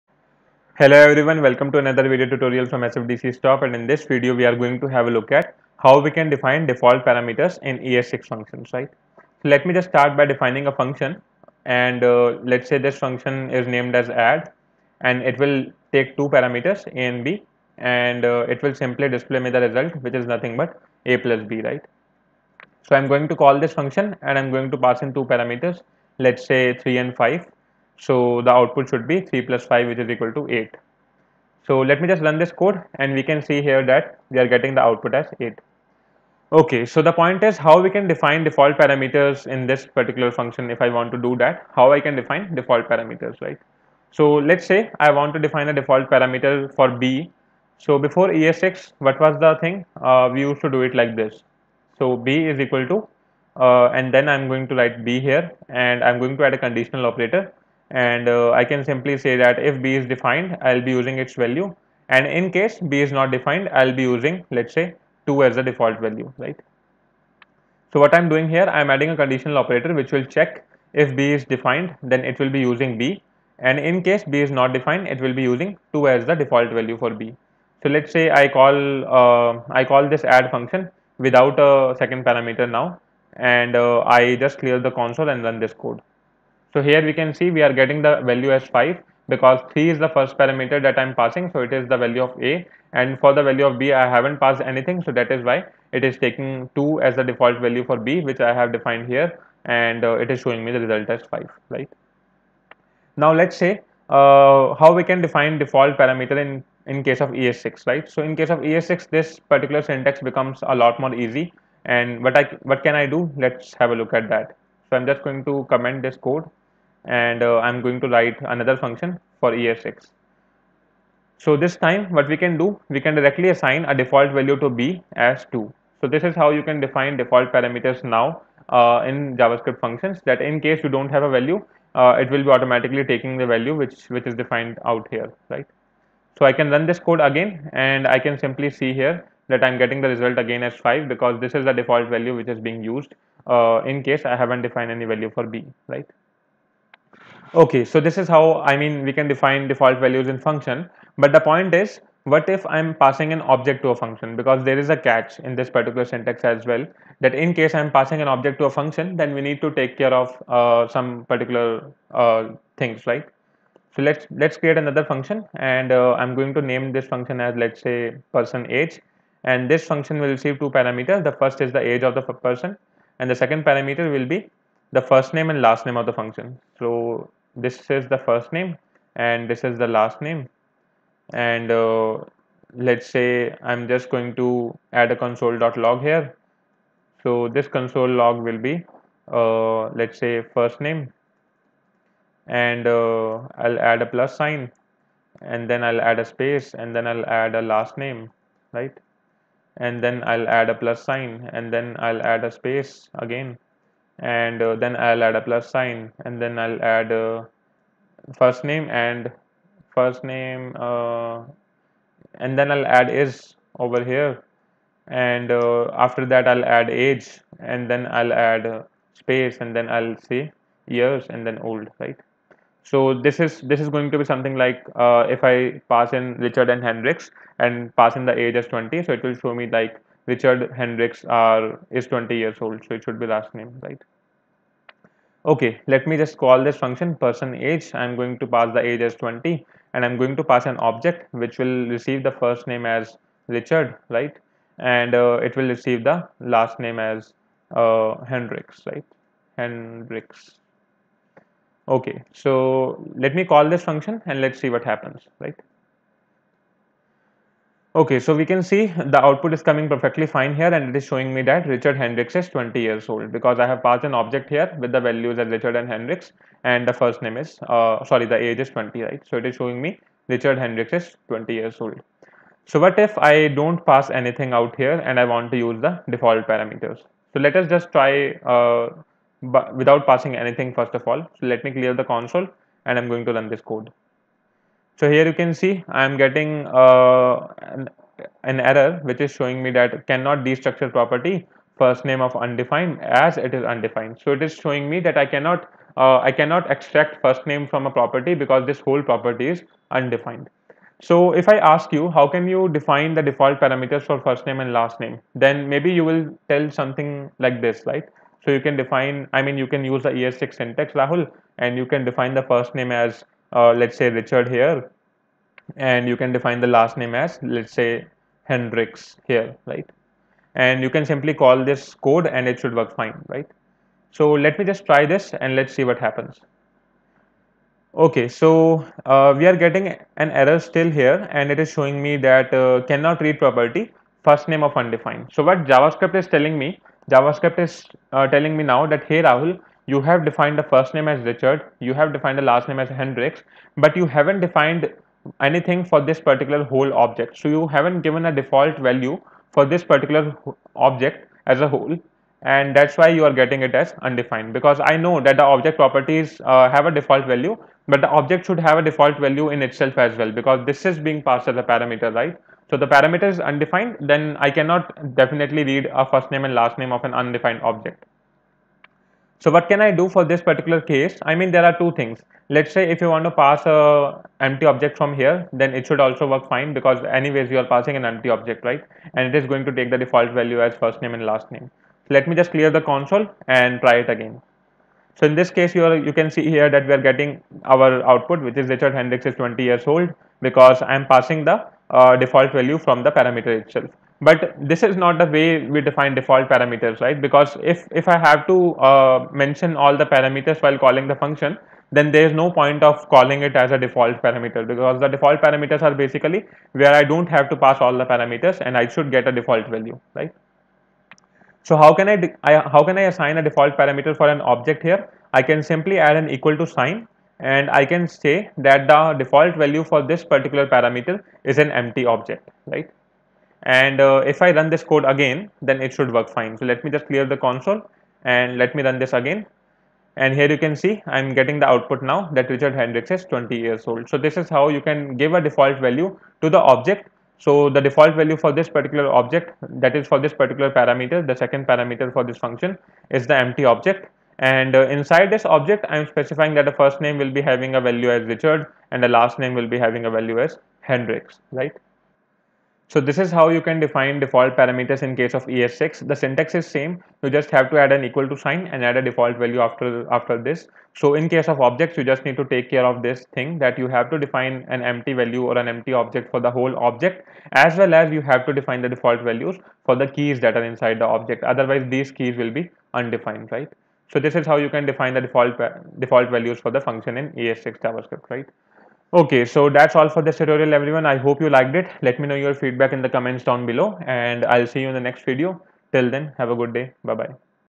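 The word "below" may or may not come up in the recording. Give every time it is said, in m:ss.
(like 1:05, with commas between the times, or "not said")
8:03.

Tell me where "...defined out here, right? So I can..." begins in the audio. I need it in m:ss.
2:14.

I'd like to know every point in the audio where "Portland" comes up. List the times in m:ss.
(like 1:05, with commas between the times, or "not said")
not said.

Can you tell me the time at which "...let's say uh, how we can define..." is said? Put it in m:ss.
1:43.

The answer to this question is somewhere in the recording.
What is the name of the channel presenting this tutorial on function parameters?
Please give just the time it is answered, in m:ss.
0:02.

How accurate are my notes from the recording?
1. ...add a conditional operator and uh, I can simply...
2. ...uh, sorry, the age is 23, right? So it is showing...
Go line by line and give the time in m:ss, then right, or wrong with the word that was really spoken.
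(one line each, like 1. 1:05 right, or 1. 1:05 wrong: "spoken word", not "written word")
1. 0:56 right
2. 4:27 wrong: "20", not "23".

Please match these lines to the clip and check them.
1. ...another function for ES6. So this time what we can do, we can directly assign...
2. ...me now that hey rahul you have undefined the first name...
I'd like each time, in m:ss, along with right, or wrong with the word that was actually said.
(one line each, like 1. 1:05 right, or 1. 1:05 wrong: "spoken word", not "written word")
1. 1:58 right
2. 5:38 wrong: "defined", not "undefined".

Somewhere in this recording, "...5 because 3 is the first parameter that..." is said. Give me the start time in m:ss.
1:28.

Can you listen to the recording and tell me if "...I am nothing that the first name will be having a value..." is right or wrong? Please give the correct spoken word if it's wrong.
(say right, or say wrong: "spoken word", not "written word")
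wrong: "specifying", not "nothing".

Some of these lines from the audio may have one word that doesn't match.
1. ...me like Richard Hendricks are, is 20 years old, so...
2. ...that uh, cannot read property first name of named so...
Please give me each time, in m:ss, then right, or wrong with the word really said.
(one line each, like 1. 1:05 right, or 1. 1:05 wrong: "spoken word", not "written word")
1. 3:49 right
2. 5:32 wrong: "undefined", not "named".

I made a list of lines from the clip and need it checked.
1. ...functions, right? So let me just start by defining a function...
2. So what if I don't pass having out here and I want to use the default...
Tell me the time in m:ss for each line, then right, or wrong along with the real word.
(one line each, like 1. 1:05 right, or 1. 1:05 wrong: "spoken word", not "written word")
1. 0:08 right
2. 4:32 wrong: "anything", not "having".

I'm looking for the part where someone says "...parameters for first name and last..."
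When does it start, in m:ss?
5:03.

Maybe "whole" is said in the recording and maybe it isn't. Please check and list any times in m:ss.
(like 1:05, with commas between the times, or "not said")
4:58, 5:46, 5:51, 7:46.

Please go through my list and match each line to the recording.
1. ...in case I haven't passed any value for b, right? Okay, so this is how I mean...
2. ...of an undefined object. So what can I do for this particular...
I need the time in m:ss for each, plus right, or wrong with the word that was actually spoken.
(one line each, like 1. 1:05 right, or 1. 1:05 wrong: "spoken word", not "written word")
1. 2:23 wrong: "defined", not "passed"
2. 6:06 right.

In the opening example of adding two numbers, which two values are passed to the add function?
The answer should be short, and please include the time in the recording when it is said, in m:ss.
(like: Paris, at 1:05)
3 and 5, at 0:26.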